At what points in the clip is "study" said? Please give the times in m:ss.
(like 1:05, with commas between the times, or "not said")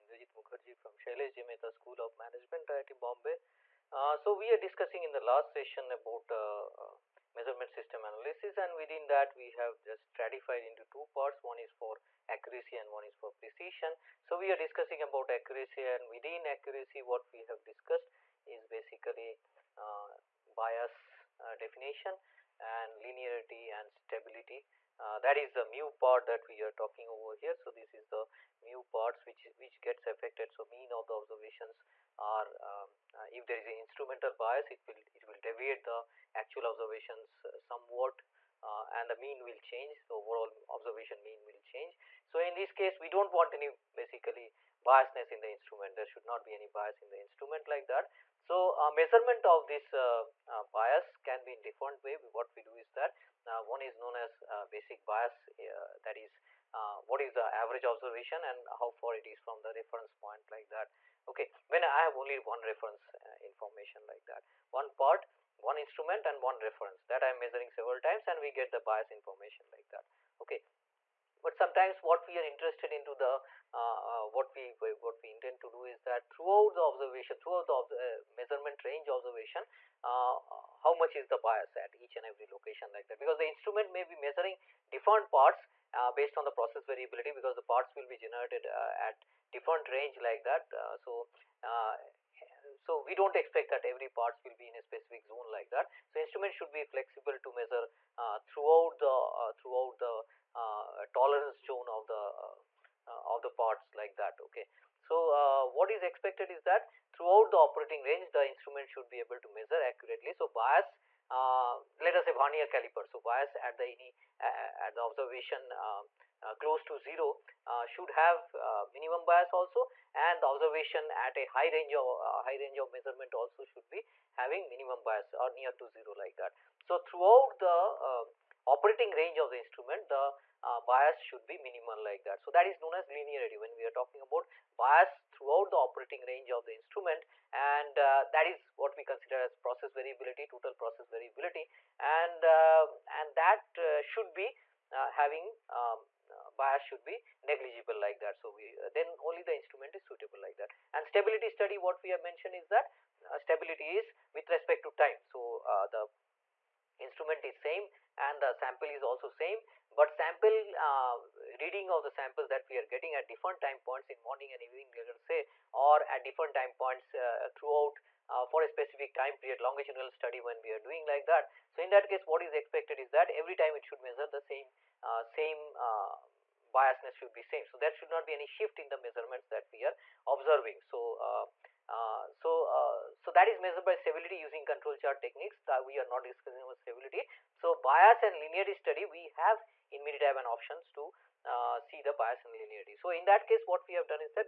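2:31, 2:50, 3:08.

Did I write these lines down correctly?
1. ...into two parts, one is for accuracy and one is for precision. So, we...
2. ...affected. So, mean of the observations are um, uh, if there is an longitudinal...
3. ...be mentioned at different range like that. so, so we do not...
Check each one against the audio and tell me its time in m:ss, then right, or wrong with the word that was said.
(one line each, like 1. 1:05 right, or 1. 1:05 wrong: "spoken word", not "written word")
1. 0:10 right
2. 0:30 wrong: "instrumental", not "longitudinal"
3. 1:28 wrong: "generated", not "mentioned".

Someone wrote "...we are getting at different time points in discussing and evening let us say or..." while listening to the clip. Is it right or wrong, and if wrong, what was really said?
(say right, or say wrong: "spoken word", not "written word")
wrong: "morning", not "discussing".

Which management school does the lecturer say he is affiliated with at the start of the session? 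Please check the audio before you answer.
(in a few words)
Shailesh Mehta School of Management.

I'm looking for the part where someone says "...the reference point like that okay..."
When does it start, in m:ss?
0:59.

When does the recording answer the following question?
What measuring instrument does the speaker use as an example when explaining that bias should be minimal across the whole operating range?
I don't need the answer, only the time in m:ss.
1:52.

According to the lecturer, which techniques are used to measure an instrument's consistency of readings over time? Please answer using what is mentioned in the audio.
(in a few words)
Control chart techniques.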